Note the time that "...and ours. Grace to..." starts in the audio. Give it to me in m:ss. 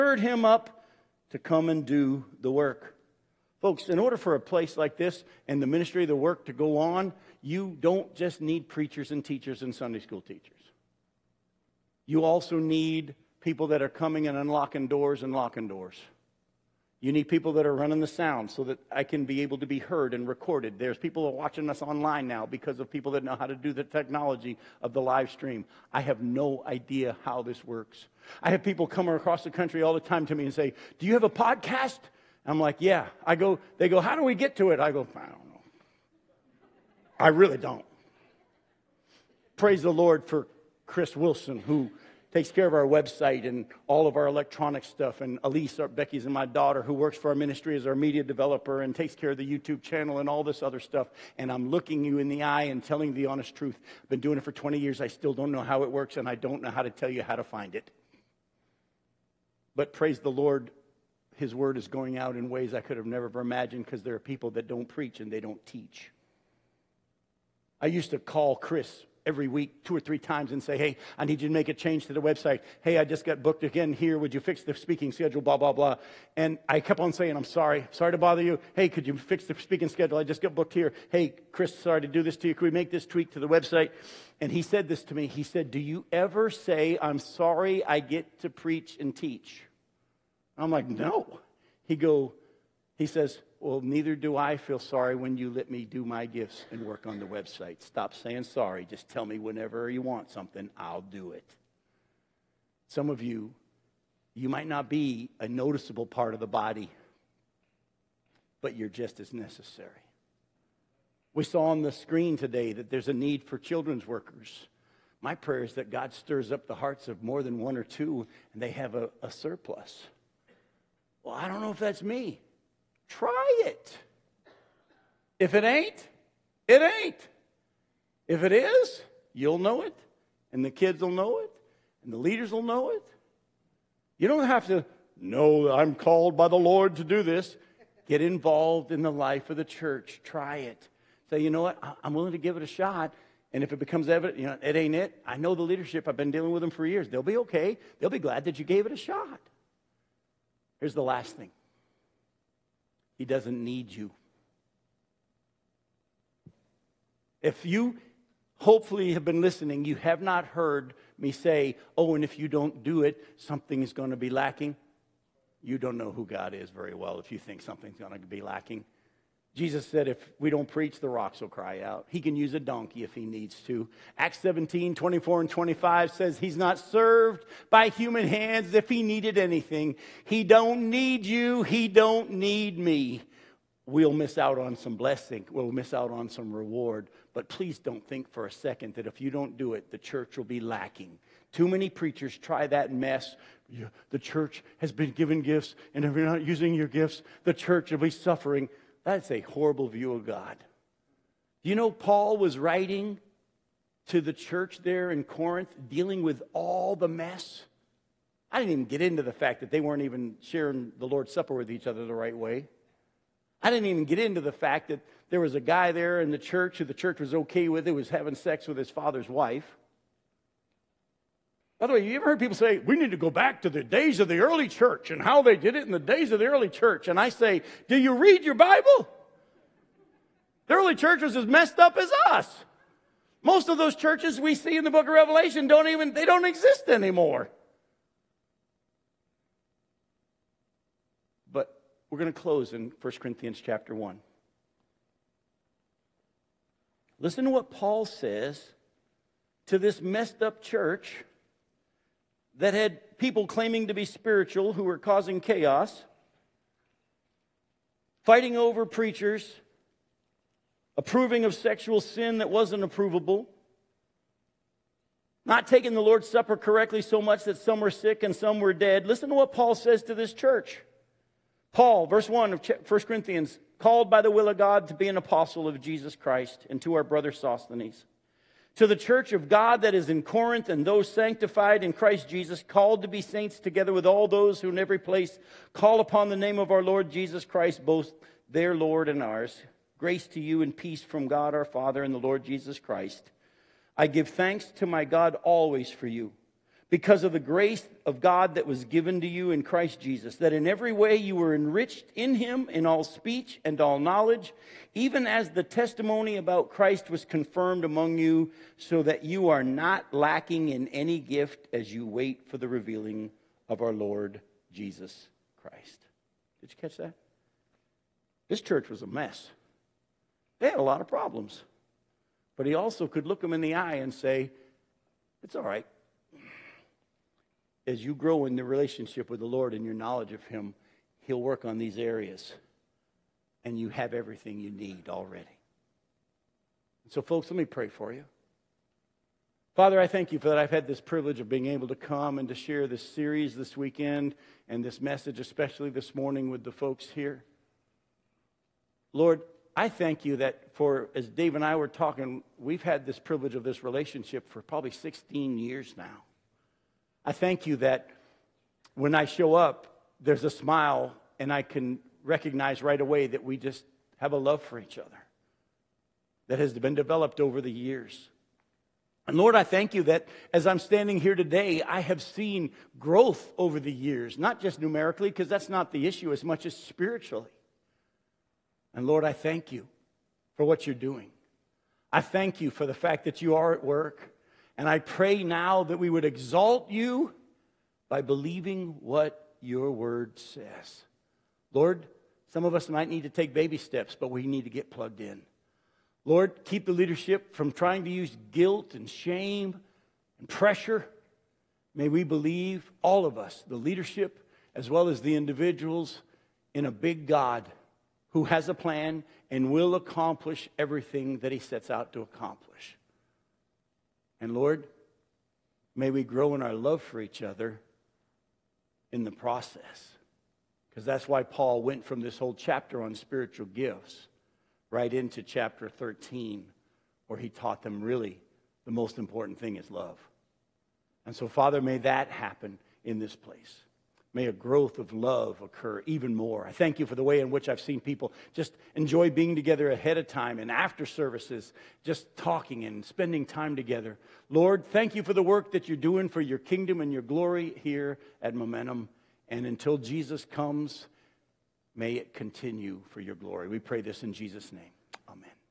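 4:49.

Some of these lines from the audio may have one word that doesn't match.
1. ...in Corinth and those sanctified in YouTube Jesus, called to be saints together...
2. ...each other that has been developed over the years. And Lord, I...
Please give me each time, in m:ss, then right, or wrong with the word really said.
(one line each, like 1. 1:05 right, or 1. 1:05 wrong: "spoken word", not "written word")
1. 4:40 wrong: "Christ", not "YouTube"
2. 6:04 right.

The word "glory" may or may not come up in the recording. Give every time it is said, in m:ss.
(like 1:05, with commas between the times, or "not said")
7:27, 7:33.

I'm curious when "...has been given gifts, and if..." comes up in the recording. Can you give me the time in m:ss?
3:14.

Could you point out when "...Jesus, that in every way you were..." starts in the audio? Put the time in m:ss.
4:59.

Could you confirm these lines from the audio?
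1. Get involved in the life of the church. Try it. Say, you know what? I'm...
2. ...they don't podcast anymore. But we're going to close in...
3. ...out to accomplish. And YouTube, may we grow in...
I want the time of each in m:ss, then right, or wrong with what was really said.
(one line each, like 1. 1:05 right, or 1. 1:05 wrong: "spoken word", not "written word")
1. 2:18 right
2. 3:56 wrong: "exist", not "podcast"
3. 6:51 wrong: "Lord", not "YouTube".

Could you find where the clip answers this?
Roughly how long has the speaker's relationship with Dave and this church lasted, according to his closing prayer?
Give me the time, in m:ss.
5:54.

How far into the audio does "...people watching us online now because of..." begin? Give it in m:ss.
0:20.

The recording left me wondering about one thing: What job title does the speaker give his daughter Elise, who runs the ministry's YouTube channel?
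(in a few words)
media developer.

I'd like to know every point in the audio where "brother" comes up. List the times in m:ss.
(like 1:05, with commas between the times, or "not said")
4:37.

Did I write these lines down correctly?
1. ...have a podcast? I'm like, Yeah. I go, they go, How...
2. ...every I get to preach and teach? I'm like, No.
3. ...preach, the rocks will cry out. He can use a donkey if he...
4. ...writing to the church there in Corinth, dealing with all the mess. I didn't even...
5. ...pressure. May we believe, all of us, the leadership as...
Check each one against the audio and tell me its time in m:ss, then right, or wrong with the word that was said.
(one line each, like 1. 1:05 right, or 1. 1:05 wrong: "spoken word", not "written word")
1. 0:31 right
2. 1:27 wrong: "sorry", not "every"
3. 2:50 right
4. 3:22 right
5. 6:40 right.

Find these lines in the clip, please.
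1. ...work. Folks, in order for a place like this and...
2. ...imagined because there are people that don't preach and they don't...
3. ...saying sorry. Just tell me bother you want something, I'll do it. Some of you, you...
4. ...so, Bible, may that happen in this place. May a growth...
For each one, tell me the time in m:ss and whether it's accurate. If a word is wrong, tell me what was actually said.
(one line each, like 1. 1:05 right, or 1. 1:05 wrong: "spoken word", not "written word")
1. 0:02 right
2. 1:03 right
3. 1:38 wrong: "whenever", not "bother"
4. 7:11 wrong: "Father", not "Bible".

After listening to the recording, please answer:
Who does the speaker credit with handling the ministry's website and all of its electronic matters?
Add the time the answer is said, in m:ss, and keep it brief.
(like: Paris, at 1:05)
Chris Wilson, at 0:40.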